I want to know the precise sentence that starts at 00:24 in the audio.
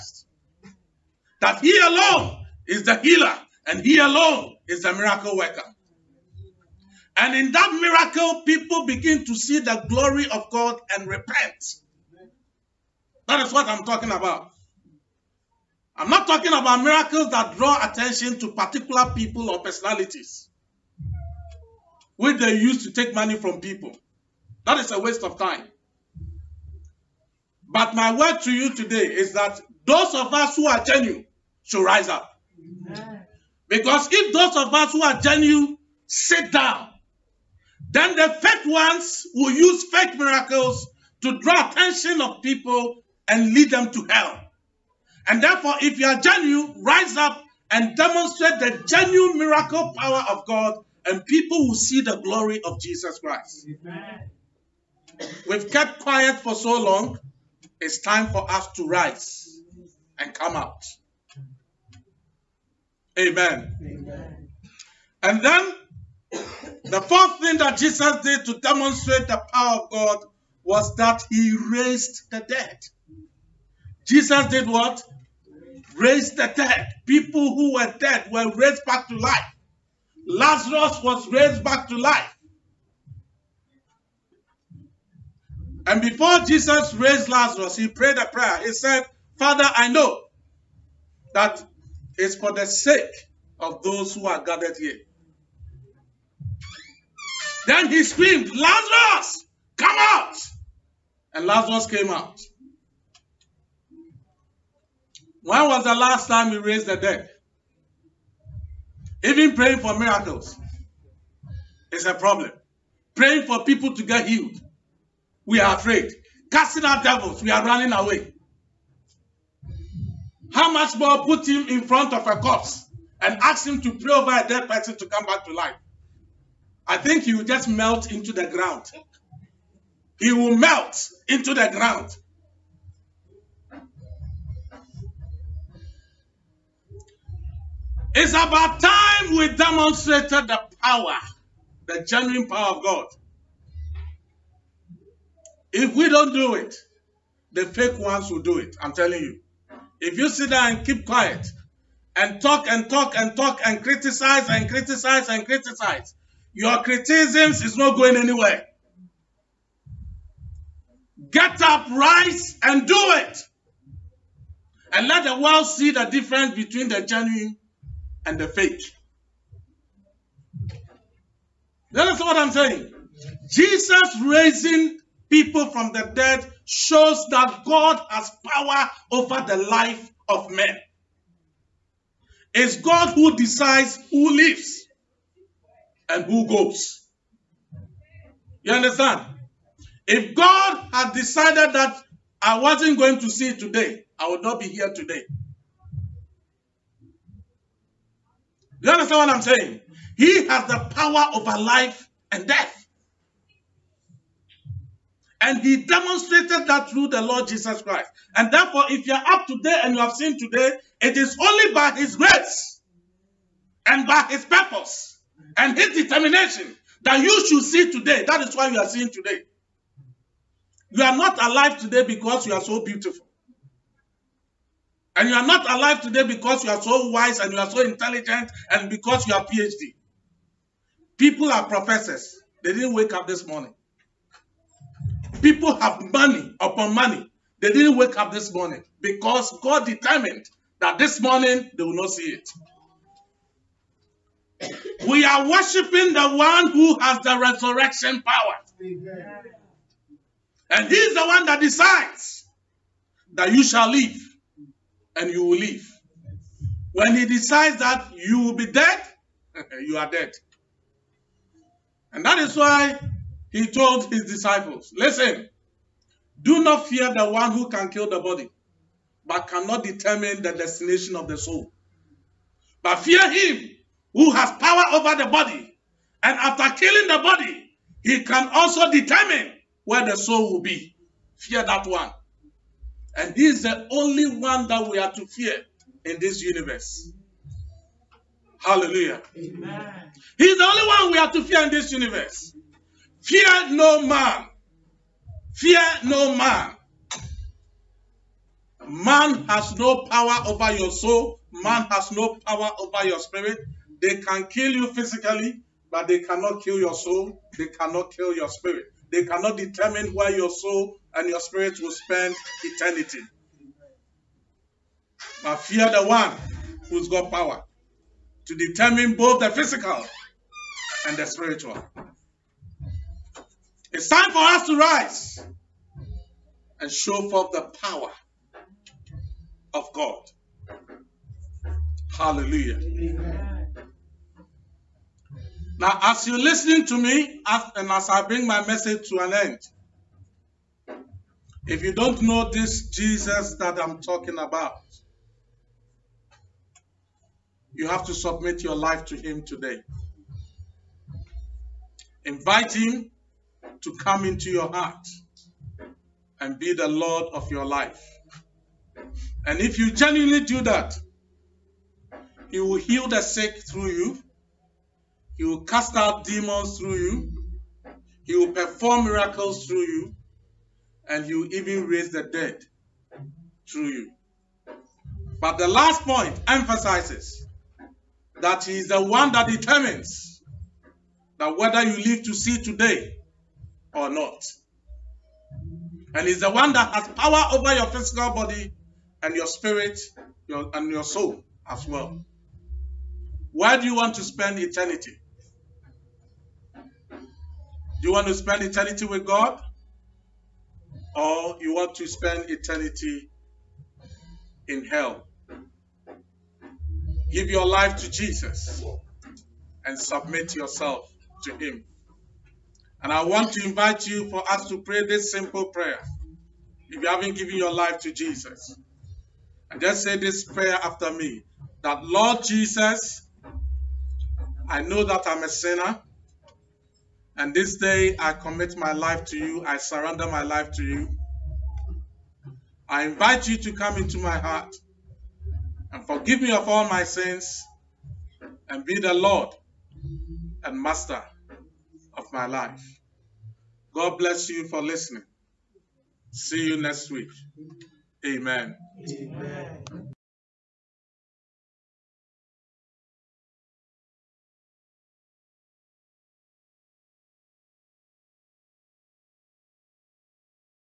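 That is a waste of time.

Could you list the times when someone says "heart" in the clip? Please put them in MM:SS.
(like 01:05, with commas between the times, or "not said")
05:54, 07:14.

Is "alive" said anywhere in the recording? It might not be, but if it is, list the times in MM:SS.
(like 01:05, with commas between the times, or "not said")
03:41, 03:45.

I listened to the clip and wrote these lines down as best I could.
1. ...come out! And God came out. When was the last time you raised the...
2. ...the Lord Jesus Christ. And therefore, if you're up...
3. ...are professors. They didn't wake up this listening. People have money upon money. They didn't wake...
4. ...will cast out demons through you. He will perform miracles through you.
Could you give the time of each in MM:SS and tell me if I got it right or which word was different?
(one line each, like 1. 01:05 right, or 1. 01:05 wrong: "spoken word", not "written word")
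1. 01:39 wrong: "Lazarus", not "God"
2. 03:27 right
3. 03:51 wrong: "morning", not "listening"
4. 06:05 right.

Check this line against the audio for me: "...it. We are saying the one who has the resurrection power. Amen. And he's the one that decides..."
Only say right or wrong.
wrong.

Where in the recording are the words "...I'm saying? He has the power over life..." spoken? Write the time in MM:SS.
03:19.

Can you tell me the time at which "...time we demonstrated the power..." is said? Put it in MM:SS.
02:18.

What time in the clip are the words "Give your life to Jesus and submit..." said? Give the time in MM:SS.
06:47.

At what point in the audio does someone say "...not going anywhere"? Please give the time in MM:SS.
02:37.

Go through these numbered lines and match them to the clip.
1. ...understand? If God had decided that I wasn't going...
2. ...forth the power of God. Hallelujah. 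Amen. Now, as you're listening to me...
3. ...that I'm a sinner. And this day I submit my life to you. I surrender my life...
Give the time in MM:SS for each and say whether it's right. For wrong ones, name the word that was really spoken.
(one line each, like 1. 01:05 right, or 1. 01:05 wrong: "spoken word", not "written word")
1. 03:08 right
2. 05:27 right
3. 07:05 wrong: "commit", not "submit".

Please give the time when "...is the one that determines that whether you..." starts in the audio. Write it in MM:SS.
06:18.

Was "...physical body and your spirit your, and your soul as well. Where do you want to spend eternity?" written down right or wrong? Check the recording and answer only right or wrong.
right.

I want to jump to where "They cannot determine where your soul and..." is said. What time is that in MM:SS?
05:09.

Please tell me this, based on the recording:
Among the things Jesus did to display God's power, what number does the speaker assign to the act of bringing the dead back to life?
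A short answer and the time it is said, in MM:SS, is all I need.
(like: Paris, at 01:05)
fourth, at 01:07.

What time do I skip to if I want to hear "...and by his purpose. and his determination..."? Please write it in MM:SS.
03:33.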